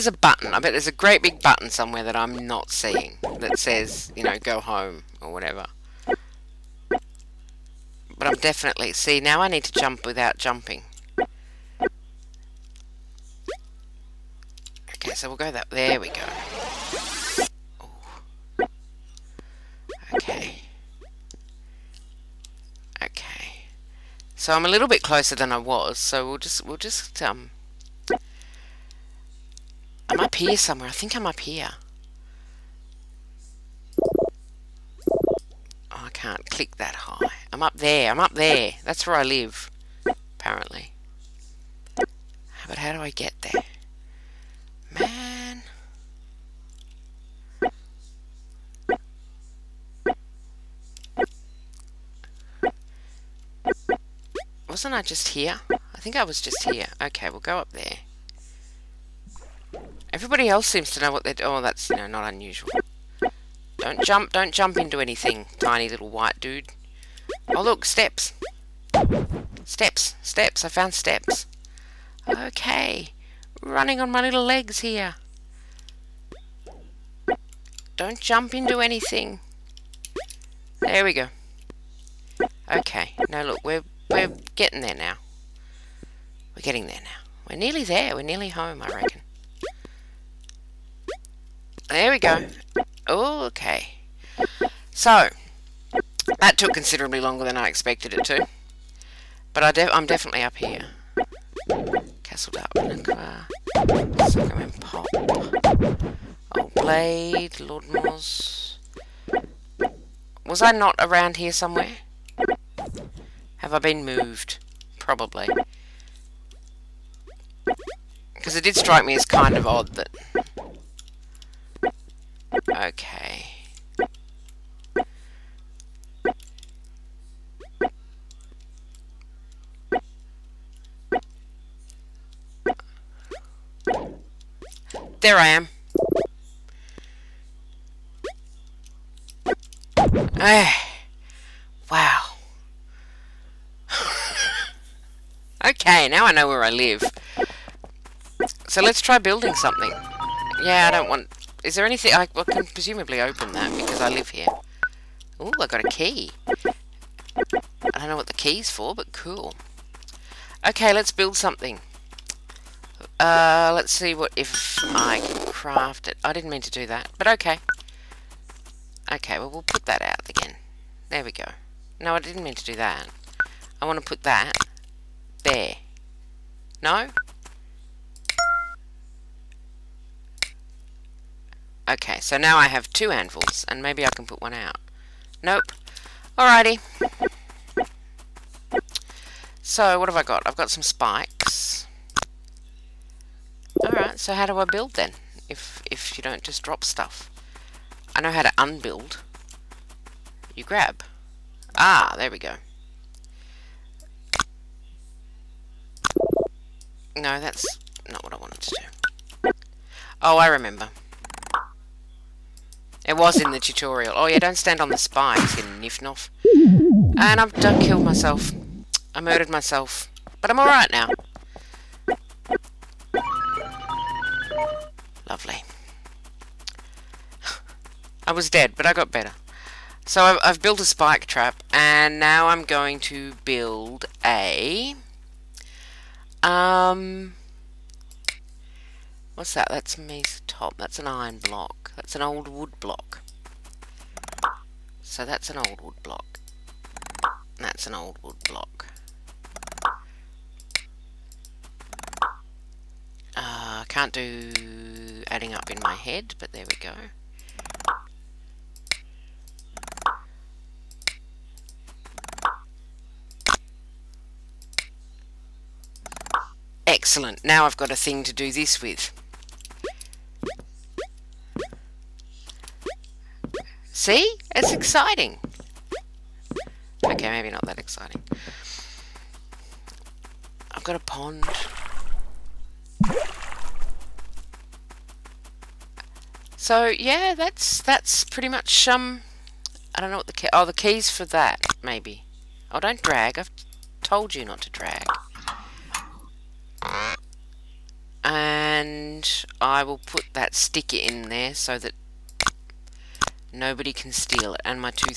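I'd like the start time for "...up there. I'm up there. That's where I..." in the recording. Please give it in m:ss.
0:37.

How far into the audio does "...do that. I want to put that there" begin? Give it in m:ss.
2:52.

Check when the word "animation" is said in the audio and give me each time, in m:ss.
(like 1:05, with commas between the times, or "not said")
not said.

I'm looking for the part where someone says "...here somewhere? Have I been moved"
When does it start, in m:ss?
1:51.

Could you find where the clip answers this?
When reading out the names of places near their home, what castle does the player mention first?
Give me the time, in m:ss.
1:42.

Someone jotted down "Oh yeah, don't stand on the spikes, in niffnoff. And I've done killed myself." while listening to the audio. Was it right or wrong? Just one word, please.
right.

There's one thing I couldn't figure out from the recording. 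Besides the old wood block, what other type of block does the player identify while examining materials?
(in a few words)
iron block.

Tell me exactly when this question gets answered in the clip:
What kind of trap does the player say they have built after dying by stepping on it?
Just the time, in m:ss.
3:50.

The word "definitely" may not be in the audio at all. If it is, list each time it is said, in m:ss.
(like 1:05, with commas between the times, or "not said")
0:08, 1:40.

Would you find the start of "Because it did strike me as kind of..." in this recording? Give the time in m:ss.
1:58.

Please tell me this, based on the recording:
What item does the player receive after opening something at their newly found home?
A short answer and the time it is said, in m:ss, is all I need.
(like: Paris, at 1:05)
a key, at 2:35.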